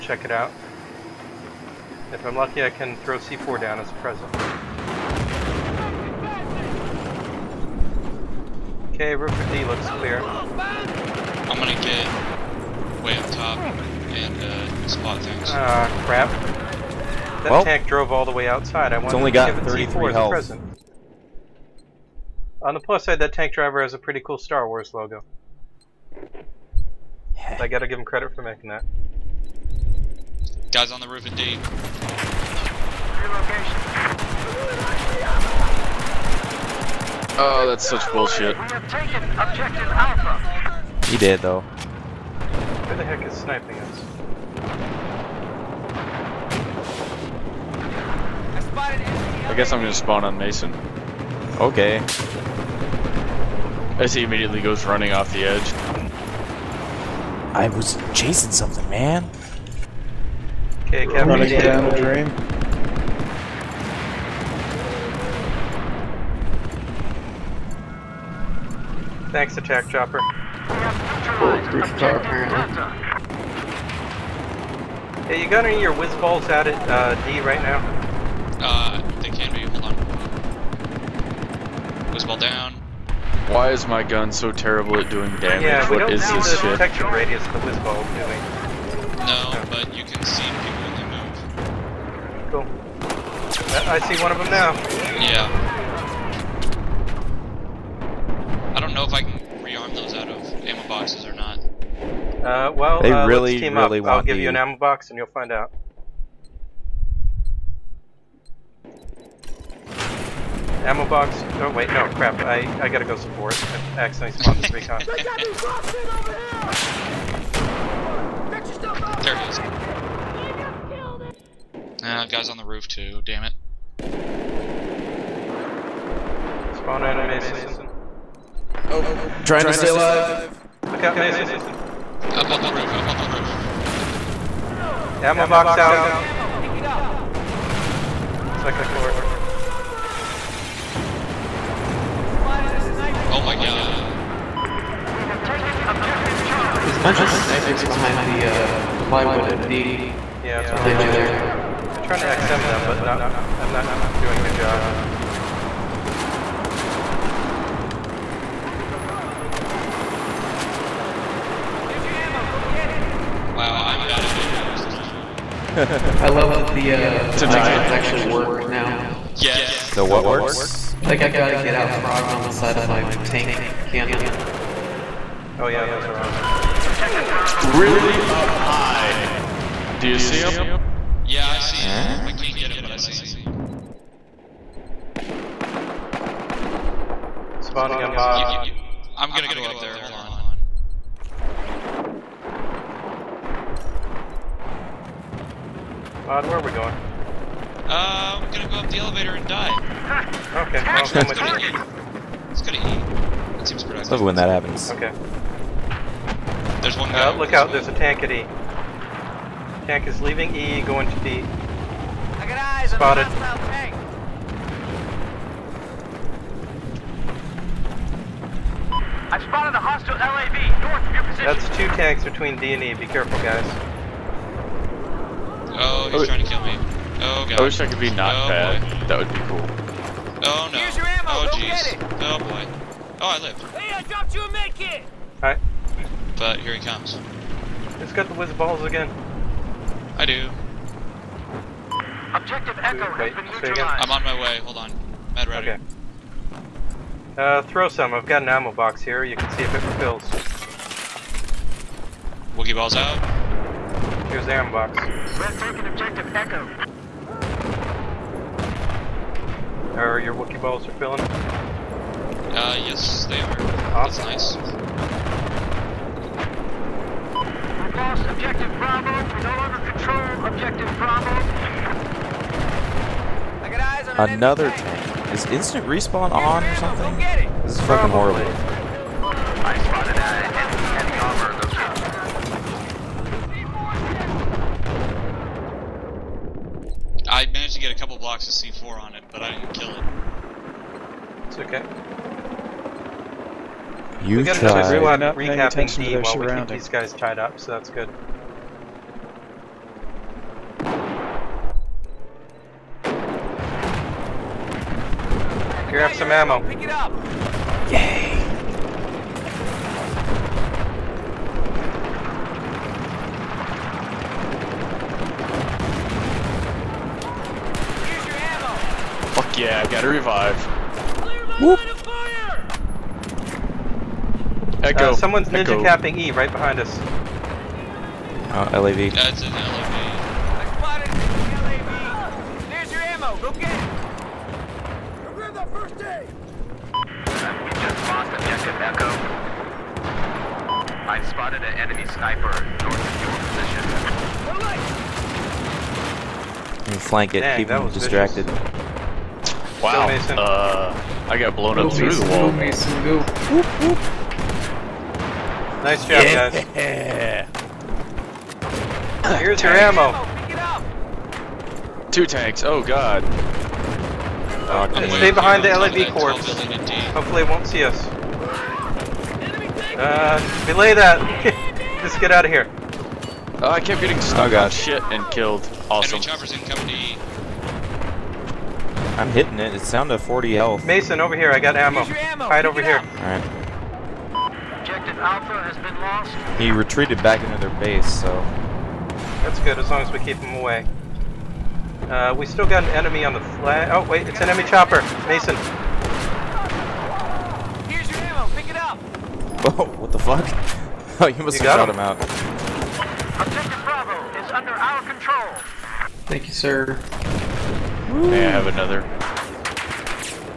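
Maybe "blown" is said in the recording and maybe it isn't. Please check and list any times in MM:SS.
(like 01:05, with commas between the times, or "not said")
05:51.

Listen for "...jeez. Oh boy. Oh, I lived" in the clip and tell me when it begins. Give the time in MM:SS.
03:51.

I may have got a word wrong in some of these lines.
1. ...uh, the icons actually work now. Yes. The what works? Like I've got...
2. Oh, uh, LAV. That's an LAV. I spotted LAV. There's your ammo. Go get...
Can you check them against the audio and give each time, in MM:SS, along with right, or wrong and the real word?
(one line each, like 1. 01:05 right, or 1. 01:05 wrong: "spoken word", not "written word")
1. 02:46 right
2. 05:28 right.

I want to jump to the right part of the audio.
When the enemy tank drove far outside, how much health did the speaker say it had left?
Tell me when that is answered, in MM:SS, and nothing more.
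00:19.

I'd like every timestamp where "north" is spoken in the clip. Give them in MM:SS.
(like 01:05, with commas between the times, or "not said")
03:40, 05:42.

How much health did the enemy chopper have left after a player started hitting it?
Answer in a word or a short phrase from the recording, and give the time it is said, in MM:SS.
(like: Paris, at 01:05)
40, at 06:20.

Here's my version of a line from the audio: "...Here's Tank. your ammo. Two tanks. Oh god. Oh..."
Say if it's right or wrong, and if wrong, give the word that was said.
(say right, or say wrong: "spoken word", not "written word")
right.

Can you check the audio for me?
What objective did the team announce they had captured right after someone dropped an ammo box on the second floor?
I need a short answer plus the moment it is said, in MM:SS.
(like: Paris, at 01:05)
Charlie, at 02:25.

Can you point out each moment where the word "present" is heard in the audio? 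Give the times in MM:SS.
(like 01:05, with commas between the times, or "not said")
00:03, 00:20.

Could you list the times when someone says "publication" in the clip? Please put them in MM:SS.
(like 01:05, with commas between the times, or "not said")
not said.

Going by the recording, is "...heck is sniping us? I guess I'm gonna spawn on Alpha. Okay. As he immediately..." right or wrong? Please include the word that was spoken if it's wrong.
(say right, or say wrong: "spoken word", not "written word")
wrong: "Mason", not "Alpha".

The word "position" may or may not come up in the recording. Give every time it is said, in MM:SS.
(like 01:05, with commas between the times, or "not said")
03:41, 05:43.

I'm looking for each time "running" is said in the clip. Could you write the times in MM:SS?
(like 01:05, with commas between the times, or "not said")
00:54, 01:01.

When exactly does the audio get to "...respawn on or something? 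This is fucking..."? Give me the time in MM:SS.
04:35.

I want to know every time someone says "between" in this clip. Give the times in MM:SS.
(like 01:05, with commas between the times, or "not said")
03:42.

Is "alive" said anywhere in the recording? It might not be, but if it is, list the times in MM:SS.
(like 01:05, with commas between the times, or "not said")
02:09.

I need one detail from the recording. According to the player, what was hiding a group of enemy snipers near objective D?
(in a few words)
plywood.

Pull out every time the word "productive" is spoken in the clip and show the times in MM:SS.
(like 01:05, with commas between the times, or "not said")
03:23.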